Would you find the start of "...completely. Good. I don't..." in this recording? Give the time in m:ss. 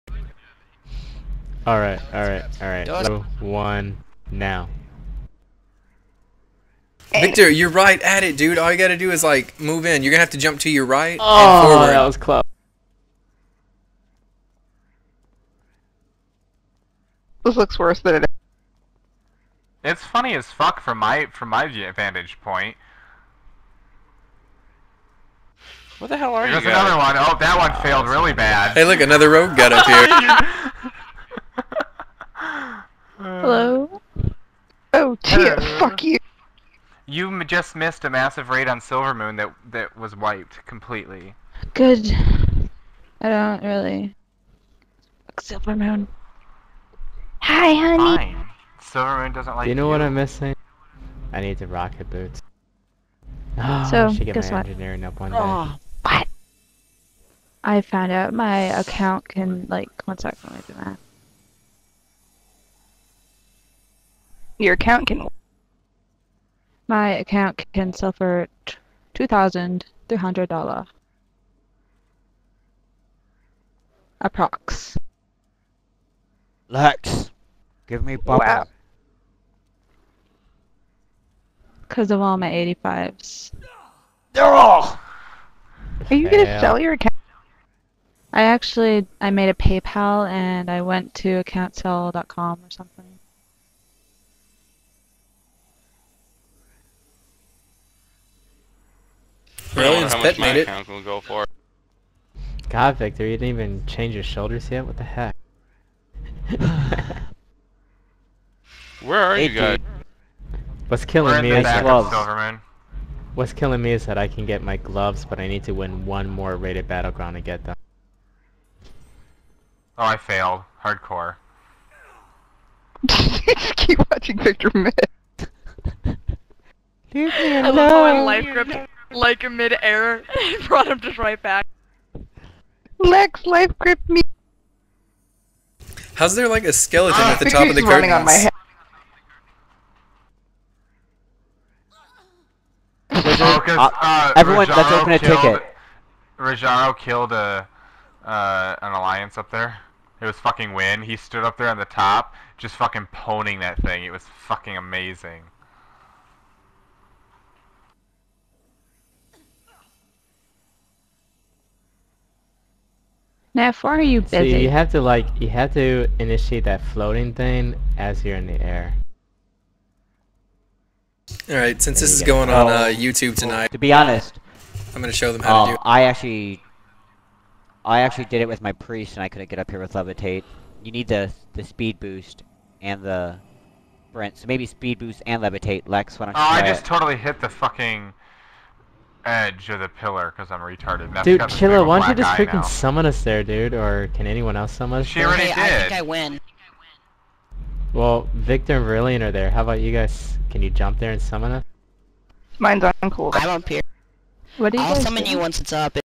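0:40.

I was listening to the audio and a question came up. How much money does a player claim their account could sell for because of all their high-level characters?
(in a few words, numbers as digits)
$2,300.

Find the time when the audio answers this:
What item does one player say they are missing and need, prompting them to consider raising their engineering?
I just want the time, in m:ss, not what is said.
0:51.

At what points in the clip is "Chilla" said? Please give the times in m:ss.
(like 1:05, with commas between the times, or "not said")
3:11.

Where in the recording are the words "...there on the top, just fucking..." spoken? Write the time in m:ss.
2:31.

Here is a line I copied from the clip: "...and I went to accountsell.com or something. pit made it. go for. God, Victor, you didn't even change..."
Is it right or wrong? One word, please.
right.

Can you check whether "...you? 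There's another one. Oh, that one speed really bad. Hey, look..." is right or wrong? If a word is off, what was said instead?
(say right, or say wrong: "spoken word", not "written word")
wrong: "failed", not "speed".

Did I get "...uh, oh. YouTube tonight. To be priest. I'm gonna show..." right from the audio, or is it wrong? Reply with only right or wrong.
wrong.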